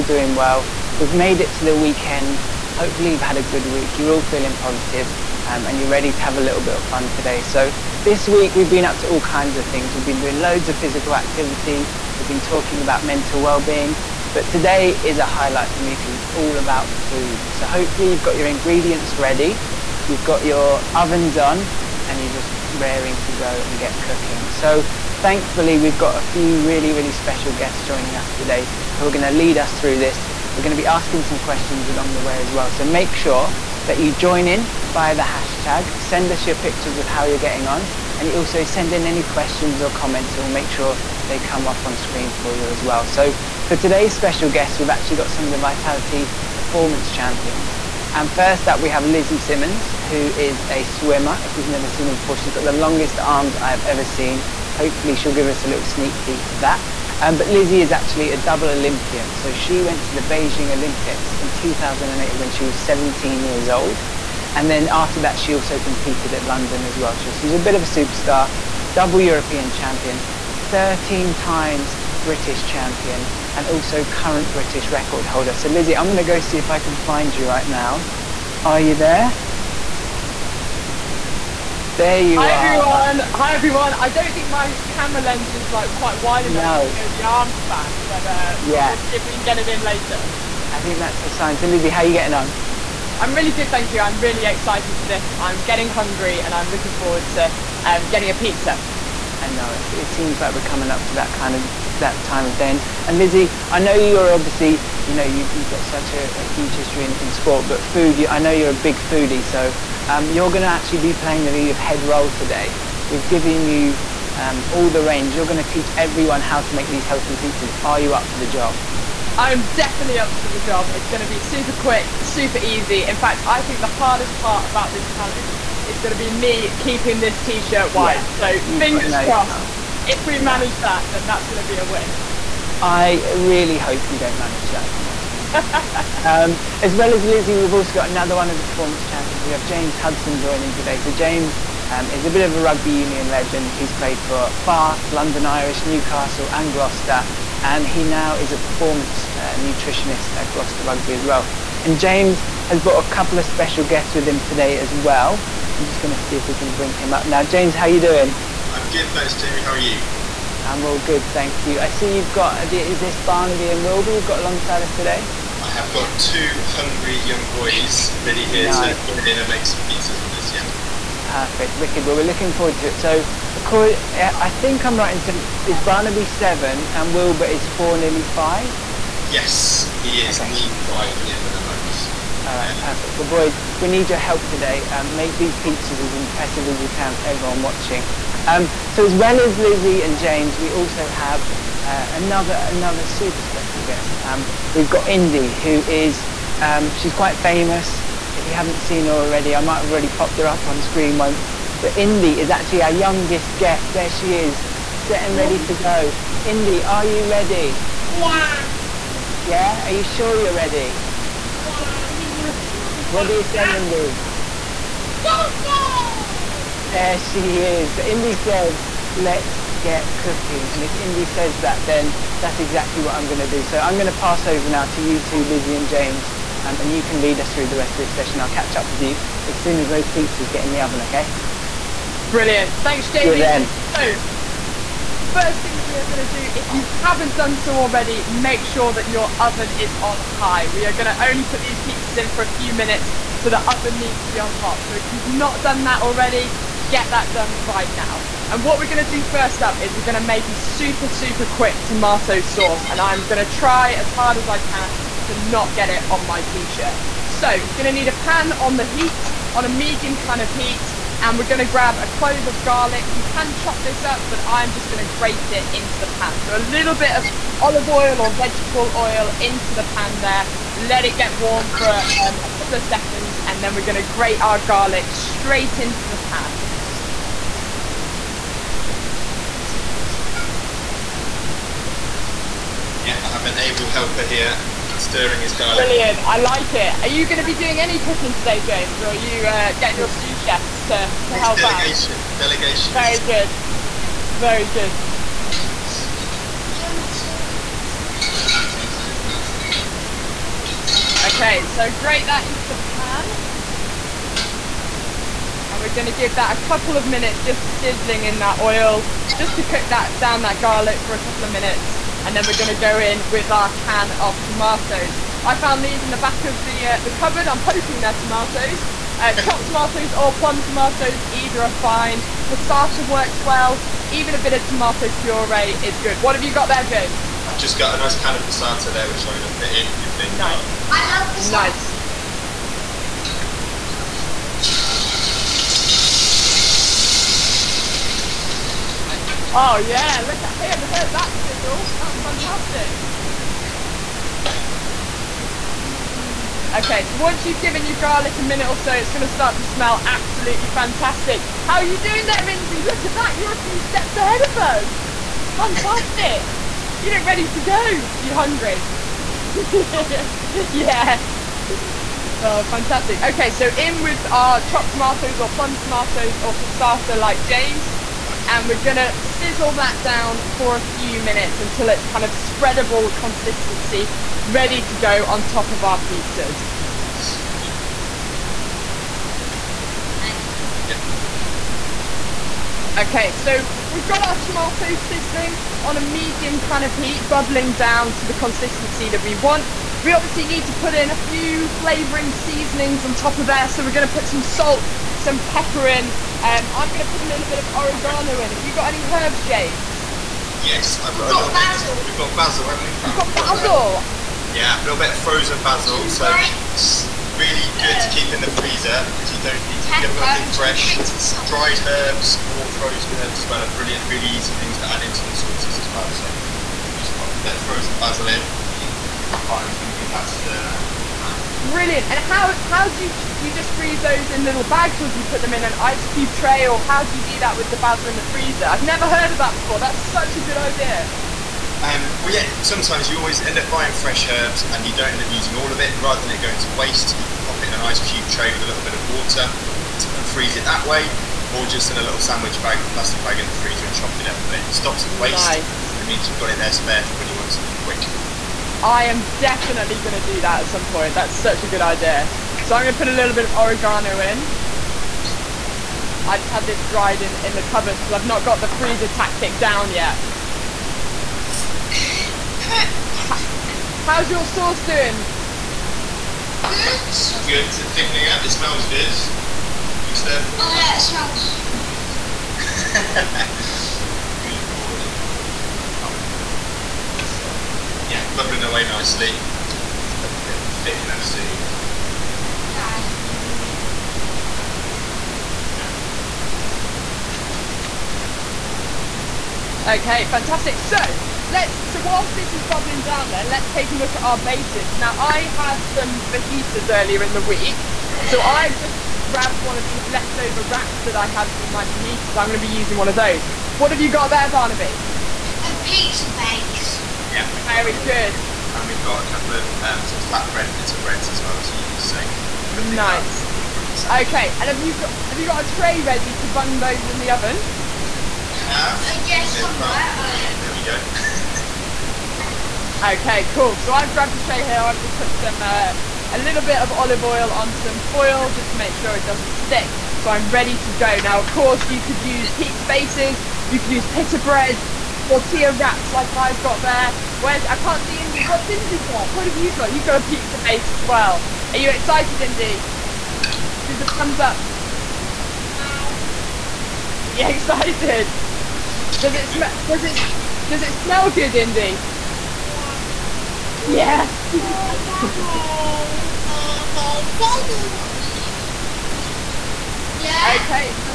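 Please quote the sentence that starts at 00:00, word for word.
We've made it to the weekend.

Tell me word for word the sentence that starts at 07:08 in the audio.
I've never heard of that before.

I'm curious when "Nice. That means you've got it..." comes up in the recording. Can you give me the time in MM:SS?
07:25.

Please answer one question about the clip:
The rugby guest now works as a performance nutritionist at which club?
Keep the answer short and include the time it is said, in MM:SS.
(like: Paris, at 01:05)
Gloucester Rugby, at 02:30.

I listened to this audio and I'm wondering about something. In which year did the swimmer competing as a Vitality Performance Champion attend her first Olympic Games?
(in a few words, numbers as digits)
2008.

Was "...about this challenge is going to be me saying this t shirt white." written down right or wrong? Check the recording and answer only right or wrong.
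wrong.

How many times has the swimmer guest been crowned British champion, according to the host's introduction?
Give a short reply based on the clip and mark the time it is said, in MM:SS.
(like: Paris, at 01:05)
13, at 01:10.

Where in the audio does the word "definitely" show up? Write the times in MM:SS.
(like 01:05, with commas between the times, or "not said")
01:59, 07:29.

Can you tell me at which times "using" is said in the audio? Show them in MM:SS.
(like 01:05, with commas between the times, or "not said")
07:15, 08:22.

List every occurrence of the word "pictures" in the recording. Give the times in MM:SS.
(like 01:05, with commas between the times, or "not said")
00:36, 03:05.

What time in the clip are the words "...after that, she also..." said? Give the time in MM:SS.
01:04.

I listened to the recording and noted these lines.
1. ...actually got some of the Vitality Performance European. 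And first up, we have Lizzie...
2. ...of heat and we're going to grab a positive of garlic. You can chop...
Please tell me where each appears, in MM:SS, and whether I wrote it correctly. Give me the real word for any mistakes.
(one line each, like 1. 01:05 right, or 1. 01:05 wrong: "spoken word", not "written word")
1. 00:44 wrong: "Champions", not "European"
2. 04:20 wrong: "clove", not "positive".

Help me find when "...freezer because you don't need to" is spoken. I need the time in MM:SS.
06:48.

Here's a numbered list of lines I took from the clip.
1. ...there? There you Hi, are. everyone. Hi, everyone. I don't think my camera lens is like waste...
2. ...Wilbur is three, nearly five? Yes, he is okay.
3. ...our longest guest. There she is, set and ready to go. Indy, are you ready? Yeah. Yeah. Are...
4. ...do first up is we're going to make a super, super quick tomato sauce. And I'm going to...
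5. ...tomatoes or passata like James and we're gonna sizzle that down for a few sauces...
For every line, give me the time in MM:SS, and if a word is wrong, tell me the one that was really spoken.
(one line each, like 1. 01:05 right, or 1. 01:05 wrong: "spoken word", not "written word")
1. 01:18 wrong: "quite", not "waste"
2. 02:57 wrong: "four", not "three"
3. 03:22 wrong: "youngest", not "longest"
4. 04:09 right
5. 06:05 wrong: "minutes", not "sauces".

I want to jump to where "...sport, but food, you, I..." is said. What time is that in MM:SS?
01:47.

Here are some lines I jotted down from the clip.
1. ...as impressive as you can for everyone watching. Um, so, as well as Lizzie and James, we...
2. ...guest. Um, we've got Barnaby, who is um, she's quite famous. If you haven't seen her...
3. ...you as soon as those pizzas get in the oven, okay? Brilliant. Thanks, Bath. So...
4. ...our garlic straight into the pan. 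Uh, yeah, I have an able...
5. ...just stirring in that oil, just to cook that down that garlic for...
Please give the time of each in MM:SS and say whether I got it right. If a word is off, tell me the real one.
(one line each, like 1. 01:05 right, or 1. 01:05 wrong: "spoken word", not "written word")
1. 03:05 right
2. 03:13 wrong: "Indy", not "Barnaby"
3. 03:49 wrong: "James", not "Bath"
4. 04:34 right
5. 05:07 wrong: "sizzling", not "stirring".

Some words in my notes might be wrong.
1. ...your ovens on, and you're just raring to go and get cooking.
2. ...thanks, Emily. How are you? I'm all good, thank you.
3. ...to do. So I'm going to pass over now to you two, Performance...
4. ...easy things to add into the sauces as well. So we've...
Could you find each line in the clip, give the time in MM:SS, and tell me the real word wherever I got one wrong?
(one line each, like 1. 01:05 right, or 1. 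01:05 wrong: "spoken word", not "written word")
1. 00:20 right
2. 02:39 wrong: "Jamie", not "Emily"
3. 03:43 wrong: "Lizzie", not "Performance"
4. 06:54 right.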